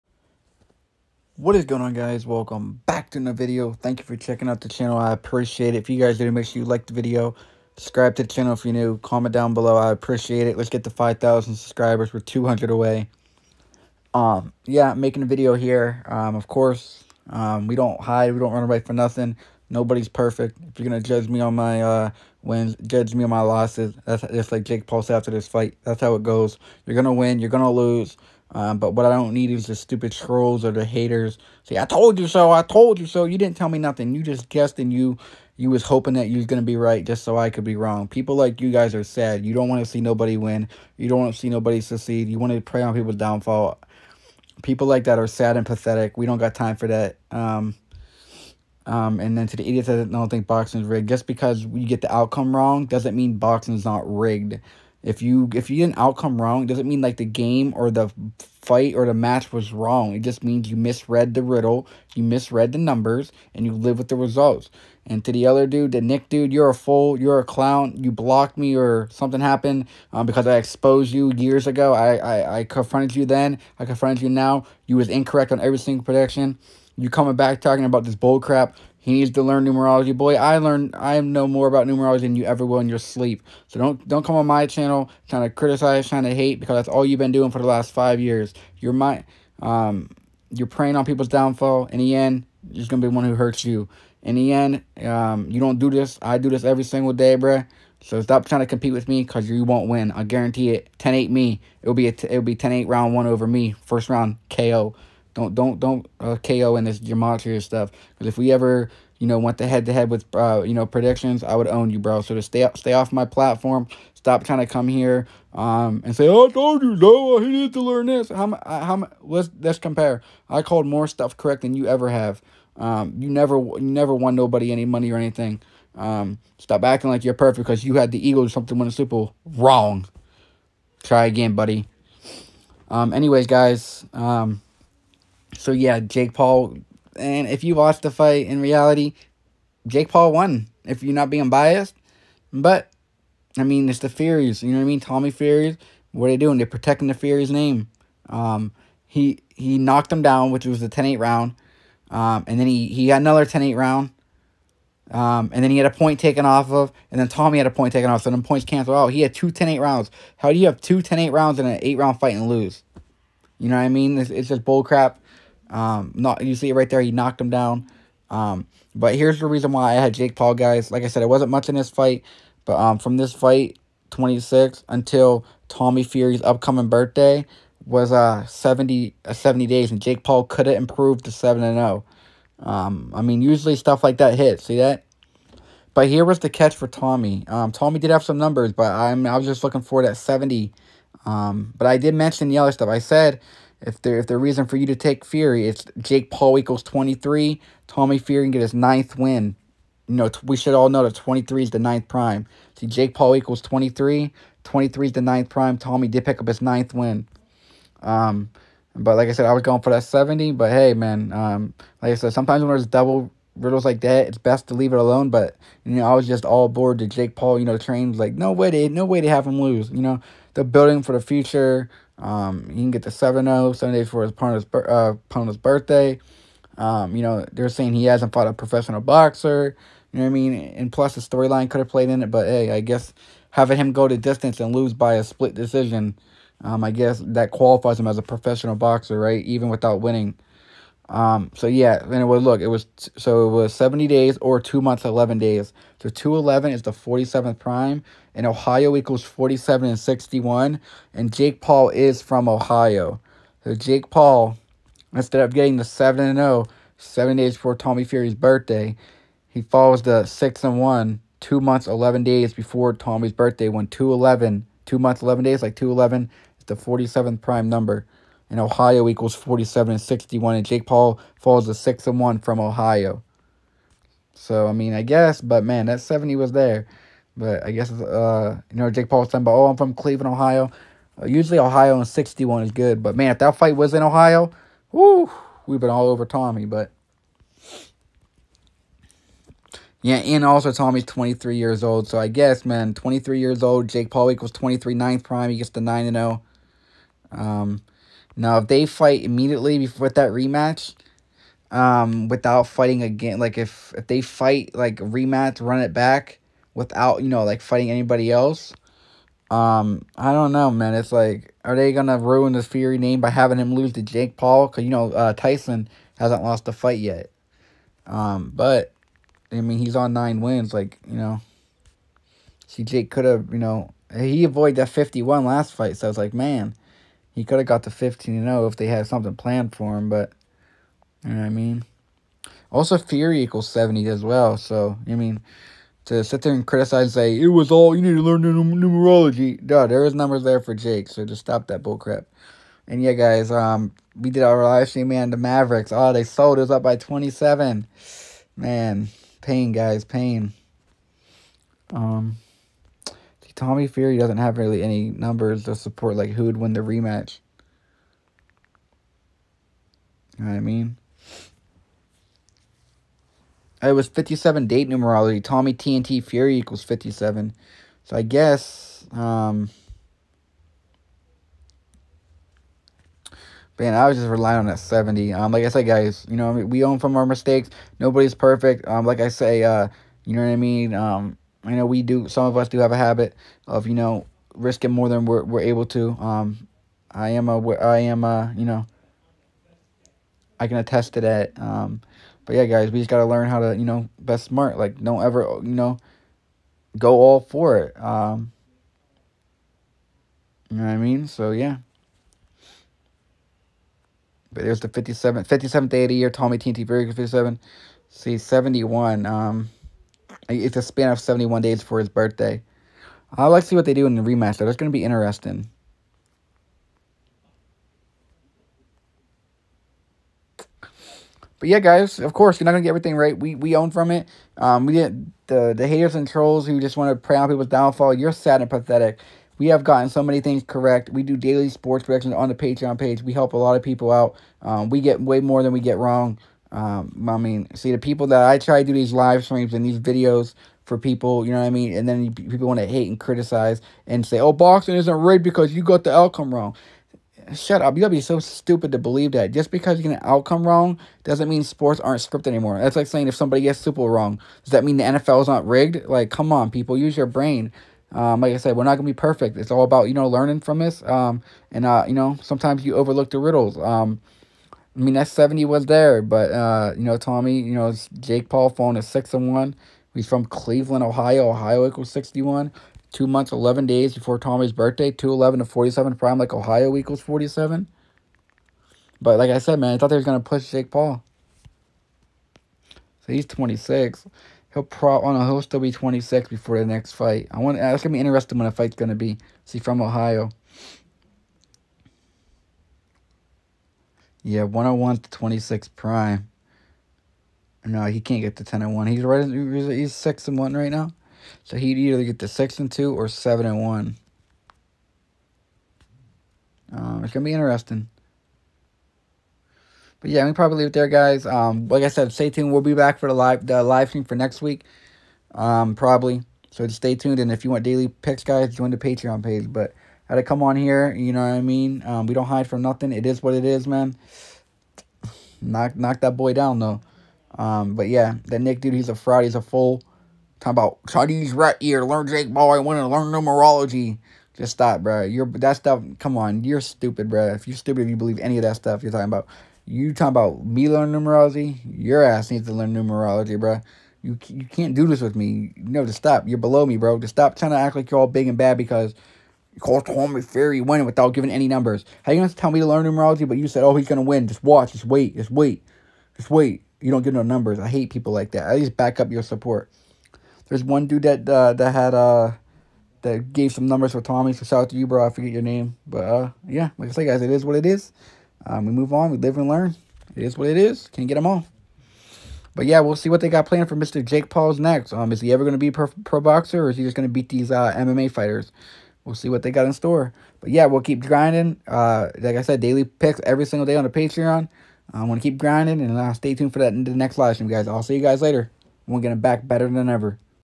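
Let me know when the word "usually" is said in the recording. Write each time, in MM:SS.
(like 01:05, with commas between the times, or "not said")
03:03, 04:41.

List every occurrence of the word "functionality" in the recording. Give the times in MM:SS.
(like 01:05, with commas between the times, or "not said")
not said.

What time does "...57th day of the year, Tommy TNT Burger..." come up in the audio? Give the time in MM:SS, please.
06:45.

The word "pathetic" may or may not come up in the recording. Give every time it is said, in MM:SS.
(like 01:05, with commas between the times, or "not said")
00:45, 07:08.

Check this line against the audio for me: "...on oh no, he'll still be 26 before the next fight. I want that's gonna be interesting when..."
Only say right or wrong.
right.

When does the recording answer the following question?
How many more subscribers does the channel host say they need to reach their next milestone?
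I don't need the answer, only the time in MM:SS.
00:12.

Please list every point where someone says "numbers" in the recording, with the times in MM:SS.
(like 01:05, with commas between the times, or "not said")
01:02, 03:08, 04:27, 05:40, 05:55, 09:11, 09:17, 09:23.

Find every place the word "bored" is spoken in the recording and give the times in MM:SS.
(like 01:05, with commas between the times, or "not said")
03:36.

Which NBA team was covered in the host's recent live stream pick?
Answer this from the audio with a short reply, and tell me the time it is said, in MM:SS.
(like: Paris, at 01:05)
Mavericks, at 05:45.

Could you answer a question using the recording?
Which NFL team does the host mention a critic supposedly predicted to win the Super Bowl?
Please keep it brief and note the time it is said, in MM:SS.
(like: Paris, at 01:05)
Eagles, at 02:08.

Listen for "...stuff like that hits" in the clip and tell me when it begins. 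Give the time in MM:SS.
03:03.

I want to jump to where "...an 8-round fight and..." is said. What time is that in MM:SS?
02:41.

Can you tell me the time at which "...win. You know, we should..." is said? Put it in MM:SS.
03:19.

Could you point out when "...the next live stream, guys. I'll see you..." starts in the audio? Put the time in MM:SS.
09:47.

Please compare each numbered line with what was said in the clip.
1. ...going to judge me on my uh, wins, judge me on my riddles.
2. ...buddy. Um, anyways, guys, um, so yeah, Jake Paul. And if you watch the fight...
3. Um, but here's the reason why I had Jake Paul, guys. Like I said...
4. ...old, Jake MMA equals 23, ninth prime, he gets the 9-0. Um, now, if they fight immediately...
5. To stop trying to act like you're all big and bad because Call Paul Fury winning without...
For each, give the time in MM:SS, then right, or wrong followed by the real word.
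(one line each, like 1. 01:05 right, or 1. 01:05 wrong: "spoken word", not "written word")
1. 00:20 wrong: "losses", not "riddles"
2. 02:11 right
3. 02:48 right
4. 04:53 wrong: "Paul", not "MMA"
5. 09:07 wrong: "Tommy", not "Paul".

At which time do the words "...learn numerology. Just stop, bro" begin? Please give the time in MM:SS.
08:53.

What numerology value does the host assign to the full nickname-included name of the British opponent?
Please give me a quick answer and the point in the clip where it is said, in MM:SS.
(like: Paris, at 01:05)
57, at 06:05.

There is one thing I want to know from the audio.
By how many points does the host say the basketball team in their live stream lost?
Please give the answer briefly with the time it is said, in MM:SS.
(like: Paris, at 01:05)
27, at 05:46.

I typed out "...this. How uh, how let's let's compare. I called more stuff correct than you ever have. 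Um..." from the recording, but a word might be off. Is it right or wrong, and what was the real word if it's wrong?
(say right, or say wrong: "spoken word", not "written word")
right.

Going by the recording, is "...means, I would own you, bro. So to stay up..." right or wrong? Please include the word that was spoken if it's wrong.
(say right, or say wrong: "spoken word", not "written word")
wrong: "predictions", not "means".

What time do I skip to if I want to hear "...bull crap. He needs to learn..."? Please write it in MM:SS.
01:18.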